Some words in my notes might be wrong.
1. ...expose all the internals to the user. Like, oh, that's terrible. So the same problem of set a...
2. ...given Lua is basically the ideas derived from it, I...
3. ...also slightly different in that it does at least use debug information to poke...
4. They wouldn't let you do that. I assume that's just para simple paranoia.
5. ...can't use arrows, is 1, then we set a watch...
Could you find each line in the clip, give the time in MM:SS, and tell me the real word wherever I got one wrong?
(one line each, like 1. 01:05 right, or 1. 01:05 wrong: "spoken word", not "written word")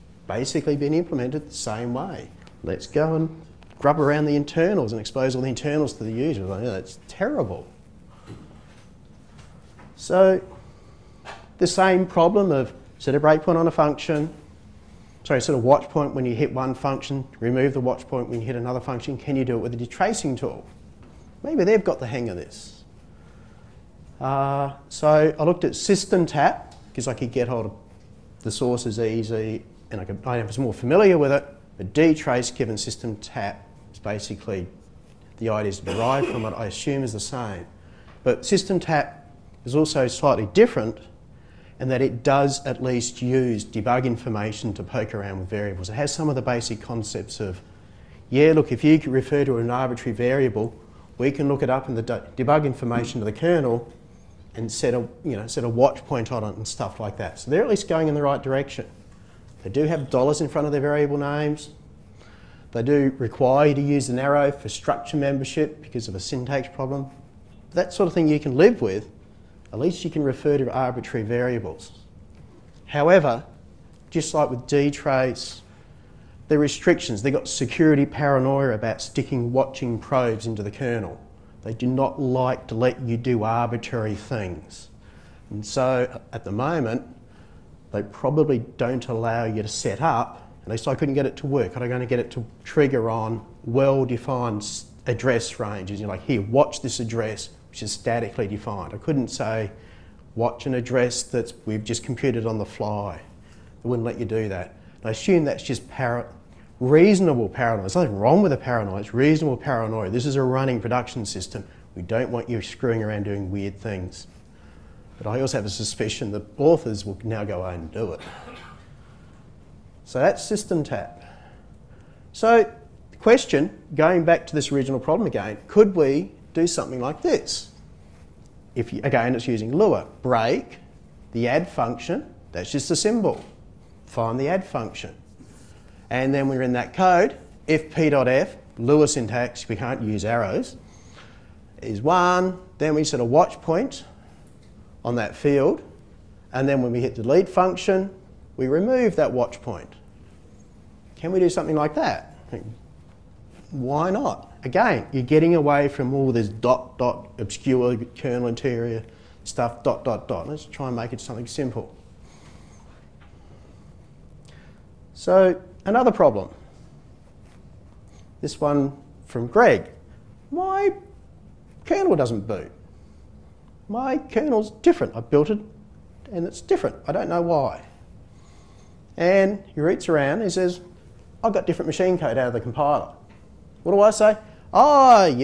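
1. 00:05 right
2. 00:32 wrong: "SystemTap", not "Lua"
3. 00:39 right
4. 01:43 wrong: "reasonable", not "simple"
5. 02:19 right.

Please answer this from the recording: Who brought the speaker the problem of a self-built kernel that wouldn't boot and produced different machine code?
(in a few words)
Greg.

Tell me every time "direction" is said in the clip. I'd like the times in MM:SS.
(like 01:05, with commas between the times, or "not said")
00:58.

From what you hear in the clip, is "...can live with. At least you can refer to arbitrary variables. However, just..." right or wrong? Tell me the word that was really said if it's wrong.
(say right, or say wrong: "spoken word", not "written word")
right.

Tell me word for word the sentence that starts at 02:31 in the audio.
Can we do something like that?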